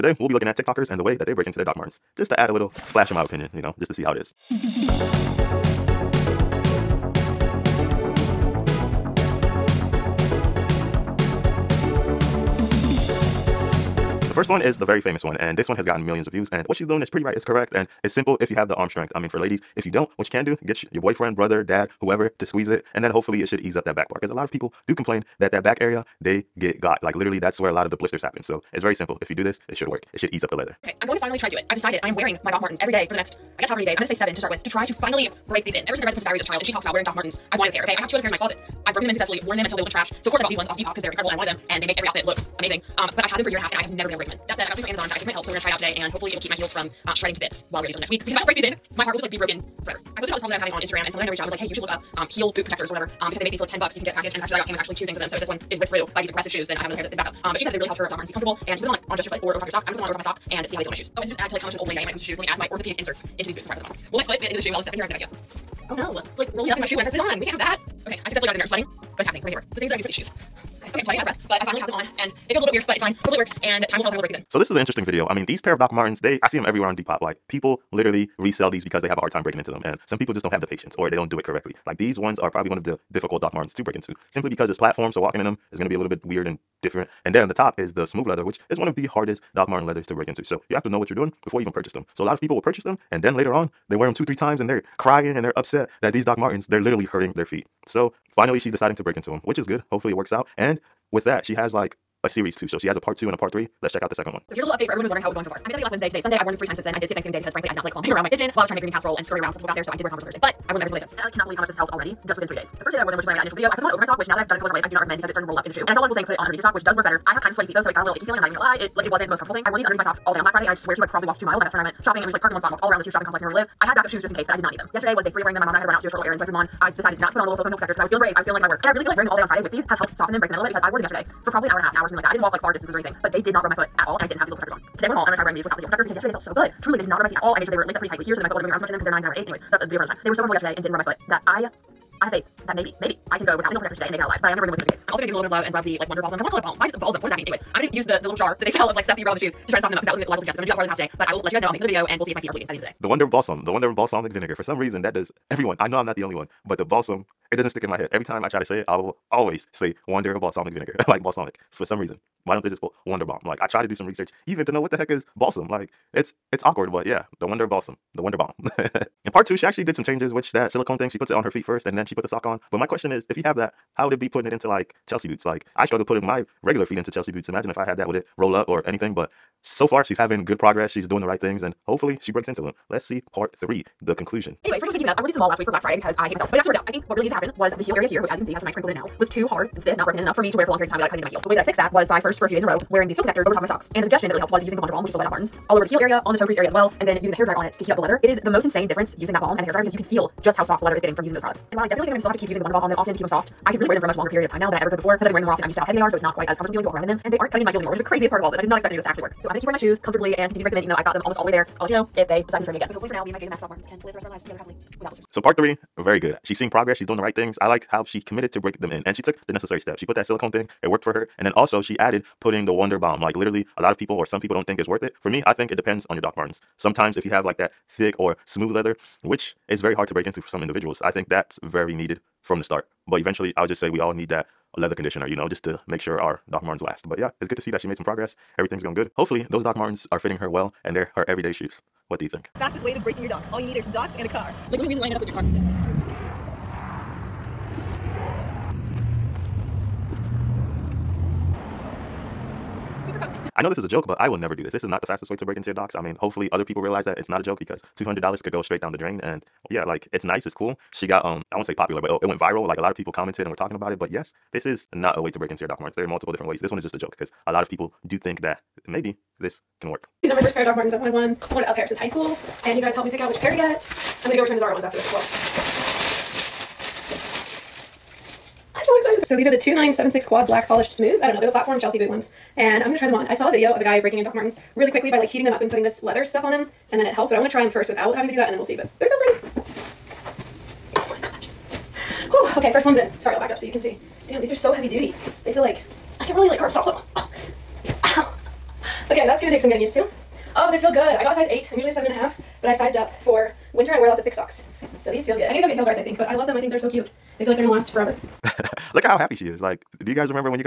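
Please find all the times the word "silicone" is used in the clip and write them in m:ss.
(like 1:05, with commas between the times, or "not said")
2:07, 2:50, 3:40.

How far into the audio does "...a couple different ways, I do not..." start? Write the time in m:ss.
1:54.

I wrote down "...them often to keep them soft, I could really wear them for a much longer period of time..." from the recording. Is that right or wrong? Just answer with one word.
right.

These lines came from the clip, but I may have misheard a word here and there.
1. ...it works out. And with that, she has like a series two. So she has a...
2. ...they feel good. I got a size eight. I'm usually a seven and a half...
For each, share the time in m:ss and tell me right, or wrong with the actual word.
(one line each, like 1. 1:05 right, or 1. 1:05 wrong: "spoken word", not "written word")
1. 1:40 right
2. 5:00 right.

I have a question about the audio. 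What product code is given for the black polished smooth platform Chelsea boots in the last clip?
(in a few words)
2976 Quad.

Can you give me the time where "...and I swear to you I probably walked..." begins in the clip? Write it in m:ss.
2:00.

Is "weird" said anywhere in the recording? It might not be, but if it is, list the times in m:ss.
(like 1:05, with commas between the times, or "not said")
1:12, 1:26.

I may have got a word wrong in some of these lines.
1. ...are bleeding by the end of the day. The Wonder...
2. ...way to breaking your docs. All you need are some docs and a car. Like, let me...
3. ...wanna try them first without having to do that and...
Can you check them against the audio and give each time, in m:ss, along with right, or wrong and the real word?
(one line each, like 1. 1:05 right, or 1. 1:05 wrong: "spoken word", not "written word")
1. 2:32 right
2. 4:02 right
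3. 4:47 right.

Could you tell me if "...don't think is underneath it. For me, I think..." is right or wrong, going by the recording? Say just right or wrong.
wrong.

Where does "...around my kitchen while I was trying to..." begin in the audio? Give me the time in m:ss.
1:48.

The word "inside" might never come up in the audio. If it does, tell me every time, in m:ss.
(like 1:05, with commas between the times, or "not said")
not said.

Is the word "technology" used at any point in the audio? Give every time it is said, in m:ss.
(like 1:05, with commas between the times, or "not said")
not said.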